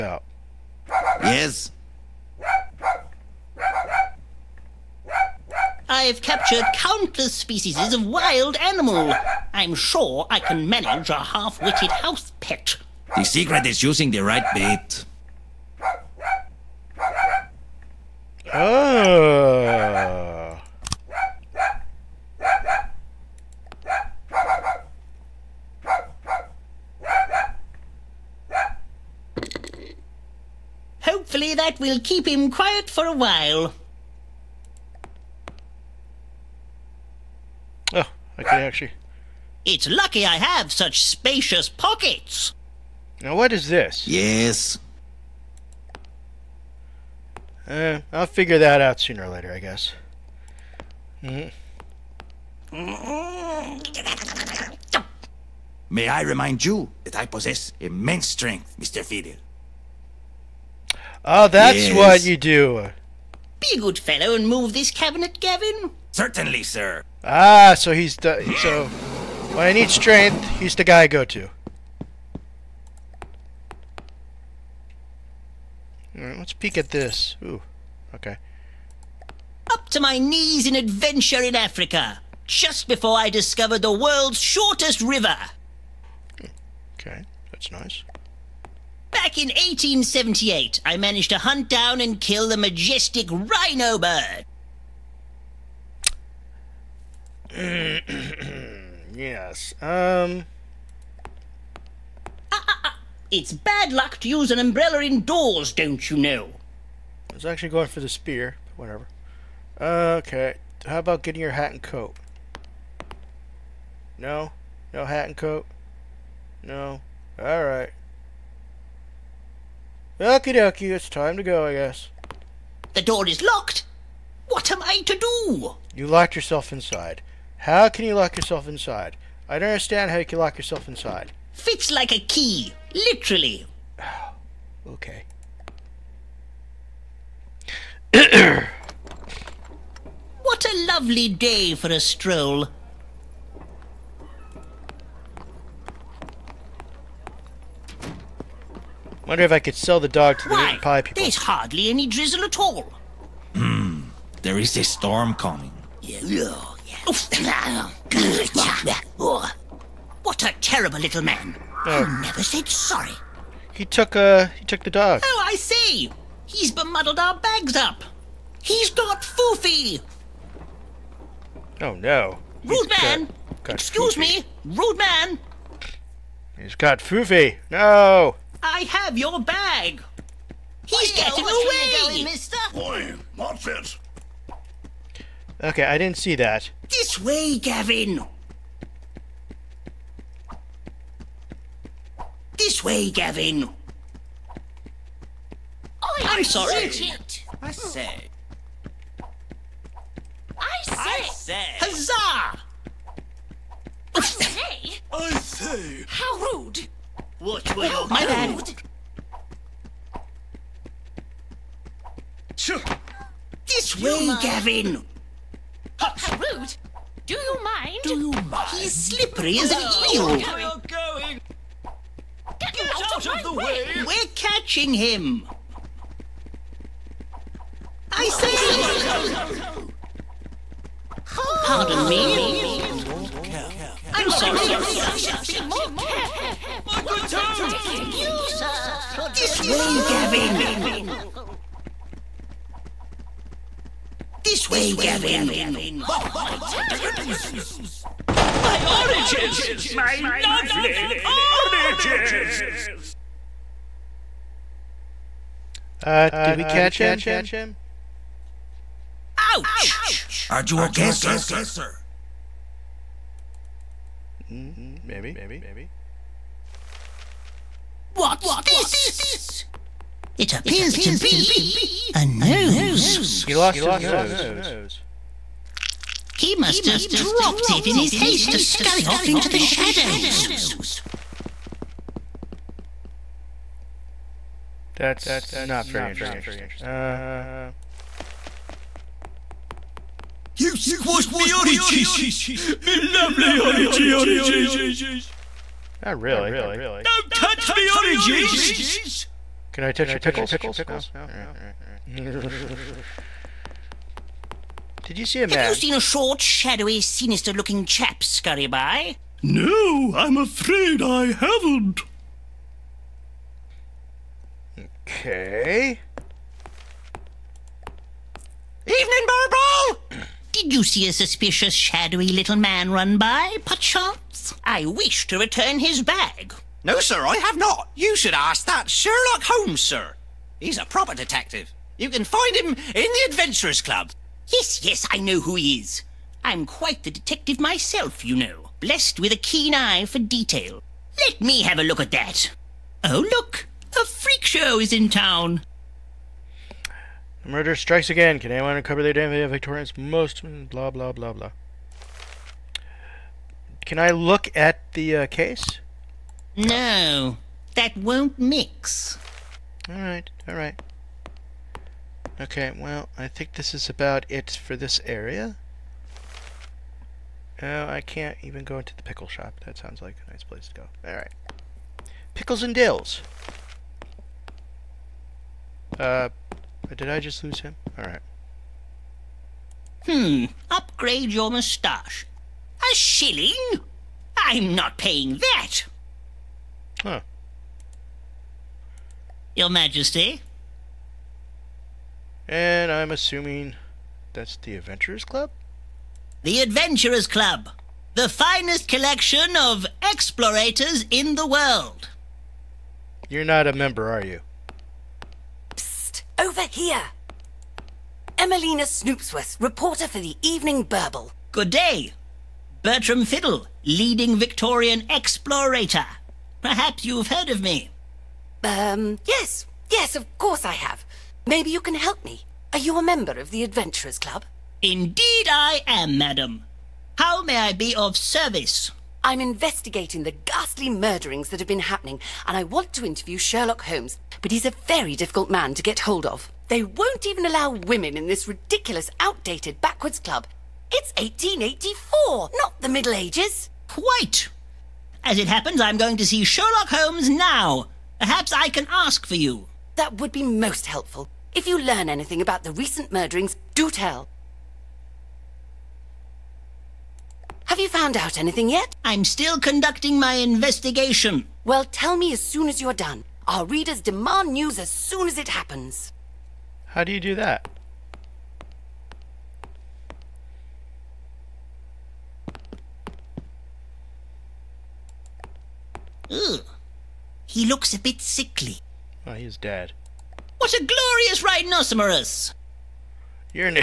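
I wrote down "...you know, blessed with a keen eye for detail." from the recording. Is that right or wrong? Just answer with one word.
right.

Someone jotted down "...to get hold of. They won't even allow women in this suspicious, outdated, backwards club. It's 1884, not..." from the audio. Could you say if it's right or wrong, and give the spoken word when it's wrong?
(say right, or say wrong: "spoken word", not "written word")
wrong: "ridiculous", not "suspicious".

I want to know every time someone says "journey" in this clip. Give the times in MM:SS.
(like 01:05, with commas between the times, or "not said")
not said.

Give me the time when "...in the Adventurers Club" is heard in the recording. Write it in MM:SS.
05:32.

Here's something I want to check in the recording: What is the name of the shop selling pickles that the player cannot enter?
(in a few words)
Pickles and Dills.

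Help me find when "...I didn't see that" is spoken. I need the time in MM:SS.
03:05.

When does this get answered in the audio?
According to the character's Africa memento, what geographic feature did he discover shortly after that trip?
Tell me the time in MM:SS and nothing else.
01:23.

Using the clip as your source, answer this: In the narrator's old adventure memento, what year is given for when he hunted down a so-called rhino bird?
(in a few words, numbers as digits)
1878.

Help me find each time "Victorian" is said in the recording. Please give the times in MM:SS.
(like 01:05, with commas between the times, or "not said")
05:49, 06:54.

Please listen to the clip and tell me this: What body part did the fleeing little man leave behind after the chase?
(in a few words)
a nose.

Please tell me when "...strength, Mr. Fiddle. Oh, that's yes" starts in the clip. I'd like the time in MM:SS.
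00:58.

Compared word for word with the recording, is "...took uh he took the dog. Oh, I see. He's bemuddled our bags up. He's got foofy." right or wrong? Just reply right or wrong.
right.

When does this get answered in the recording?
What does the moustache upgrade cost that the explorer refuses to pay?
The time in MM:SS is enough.
06:22.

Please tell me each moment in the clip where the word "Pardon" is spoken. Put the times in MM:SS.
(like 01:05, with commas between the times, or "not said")
03:51.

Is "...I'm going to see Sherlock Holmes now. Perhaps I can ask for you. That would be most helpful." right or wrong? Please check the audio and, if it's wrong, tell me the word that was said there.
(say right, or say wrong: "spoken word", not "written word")
right.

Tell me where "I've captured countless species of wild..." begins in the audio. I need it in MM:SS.
00:05.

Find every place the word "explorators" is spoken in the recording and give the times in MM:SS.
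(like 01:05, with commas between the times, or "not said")
06:40, 06:55.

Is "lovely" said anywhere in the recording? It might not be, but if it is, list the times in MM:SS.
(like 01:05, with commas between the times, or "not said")
02:20, 04:10, 04:53.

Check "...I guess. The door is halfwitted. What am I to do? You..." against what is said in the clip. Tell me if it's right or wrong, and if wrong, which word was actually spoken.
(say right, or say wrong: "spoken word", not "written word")
wrong: "locked", not "halfwitted".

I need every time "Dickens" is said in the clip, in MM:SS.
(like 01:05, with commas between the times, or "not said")
03:57, 04:06.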